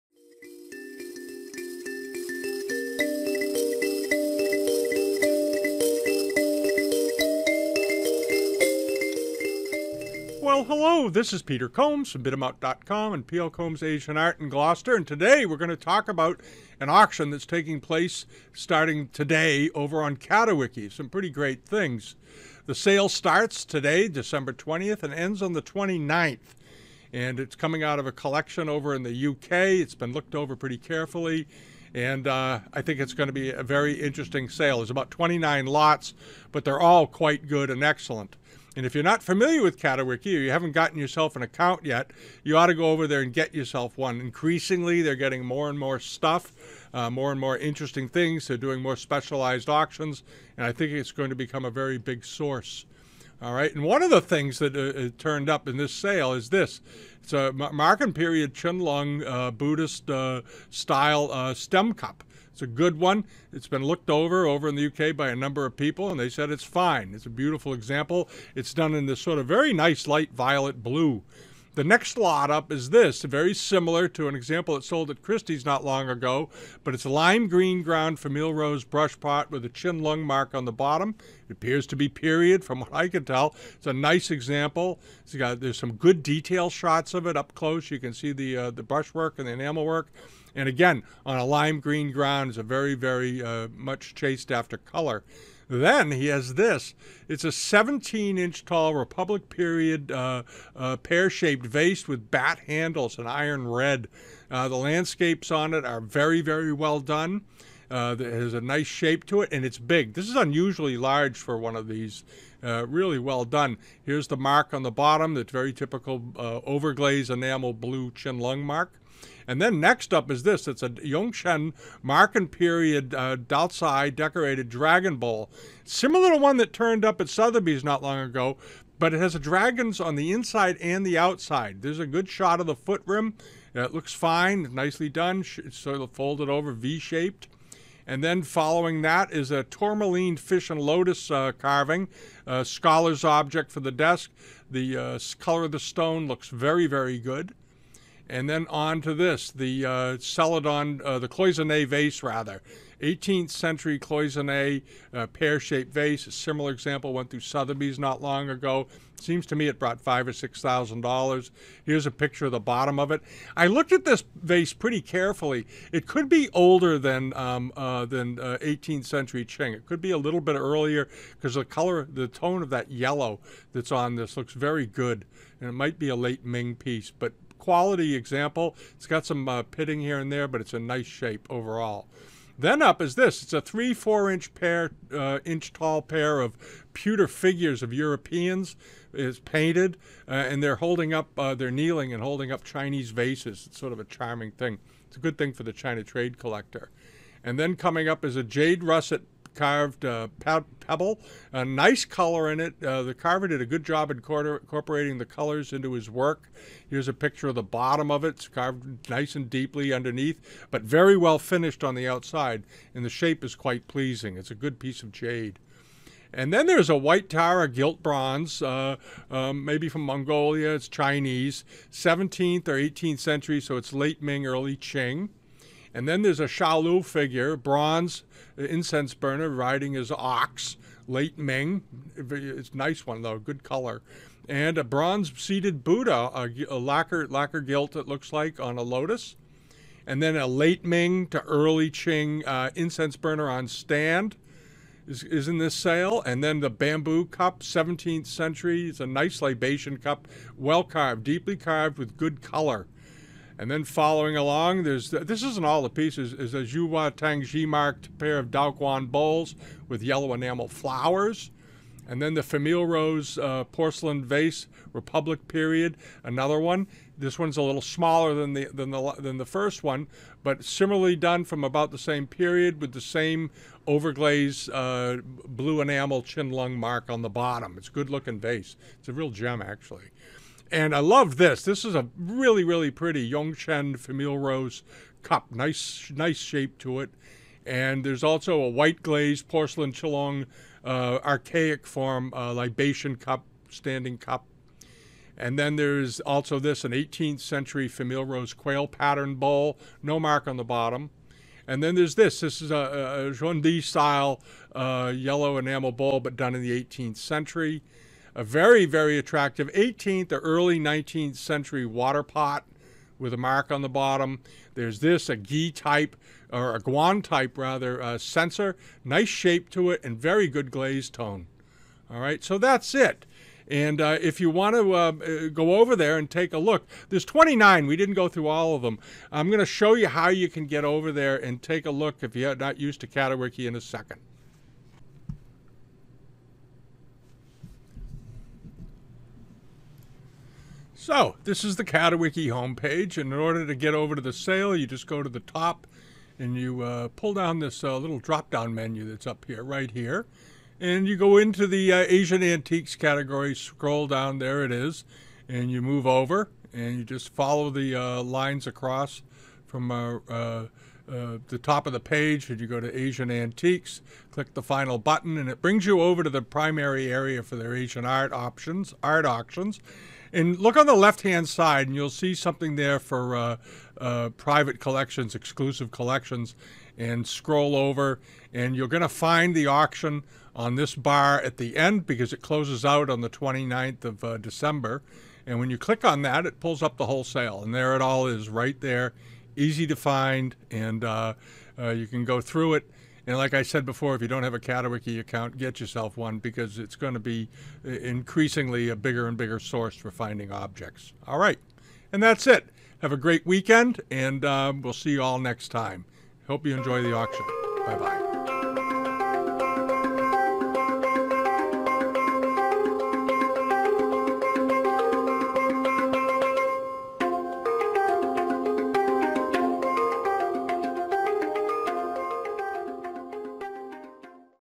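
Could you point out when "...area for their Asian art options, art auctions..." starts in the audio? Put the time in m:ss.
6:07.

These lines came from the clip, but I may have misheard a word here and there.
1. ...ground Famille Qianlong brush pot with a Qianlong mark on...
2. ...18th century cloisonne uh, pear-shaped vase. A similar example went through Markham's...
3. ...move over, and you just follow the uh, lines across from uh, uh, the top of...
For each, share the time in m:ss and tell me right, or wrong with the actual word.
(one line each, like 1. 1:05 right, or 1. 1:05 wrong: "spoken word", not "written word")
1. 1:17 wrong: "Rose", not "Qianlong"
2. 2:33 wrong: "Sotheby", not "Markham"
3. 5:55 right.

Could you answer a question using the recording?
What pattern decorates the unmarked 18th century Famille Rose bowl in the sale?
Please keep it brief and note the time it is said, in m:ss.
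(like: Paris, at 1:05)
quail, at 4:58.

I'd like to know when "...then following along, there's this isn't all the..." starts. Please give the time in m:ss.
4:13.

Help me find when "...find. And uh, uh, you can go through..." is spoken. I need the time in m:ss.
6:29.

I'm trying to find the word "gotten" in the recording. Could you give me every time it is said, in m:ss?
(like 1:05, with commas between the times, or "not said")
0:40.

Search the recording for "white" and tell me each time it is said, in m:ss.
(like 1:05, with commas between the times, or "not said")
3:36, 4:48.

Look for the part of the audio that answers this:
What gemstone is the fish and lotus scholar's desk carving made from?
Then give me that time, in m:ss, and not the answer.
2:19.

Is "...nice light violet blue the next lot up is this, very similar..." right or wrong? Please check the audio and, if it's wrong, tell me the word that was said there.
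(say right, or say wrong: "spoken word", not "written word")
right.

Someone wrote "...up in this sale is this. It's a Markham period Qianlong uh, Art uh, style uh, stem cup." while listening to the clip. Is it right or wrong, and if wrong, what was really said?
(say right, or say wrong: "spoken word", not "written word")
wrong: "Buddhist", not "Art".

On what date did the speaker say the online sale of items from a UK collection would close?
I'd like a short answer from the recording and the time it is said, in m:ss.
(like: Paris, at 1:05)
December 29, at 0:25.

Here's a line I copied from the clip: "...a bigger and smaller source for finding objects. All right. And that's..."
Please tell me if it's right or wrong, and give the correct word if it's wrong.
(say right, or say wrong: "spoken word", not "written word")
wrong: "bigger", not "smaller".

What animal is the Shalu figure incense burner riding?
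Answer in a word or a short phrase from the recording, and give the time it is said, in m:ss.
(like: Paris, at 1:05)
ox, at 3:50.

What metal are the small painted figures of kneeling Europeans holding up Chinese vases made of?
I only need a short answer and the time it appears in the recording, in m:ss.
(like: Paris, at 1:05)
pewter, at 3:06.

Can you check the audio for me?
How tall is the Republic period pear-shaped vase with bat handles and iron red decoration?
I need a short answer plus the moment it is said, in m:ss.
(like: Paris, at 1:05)
17 inches, at 1:37.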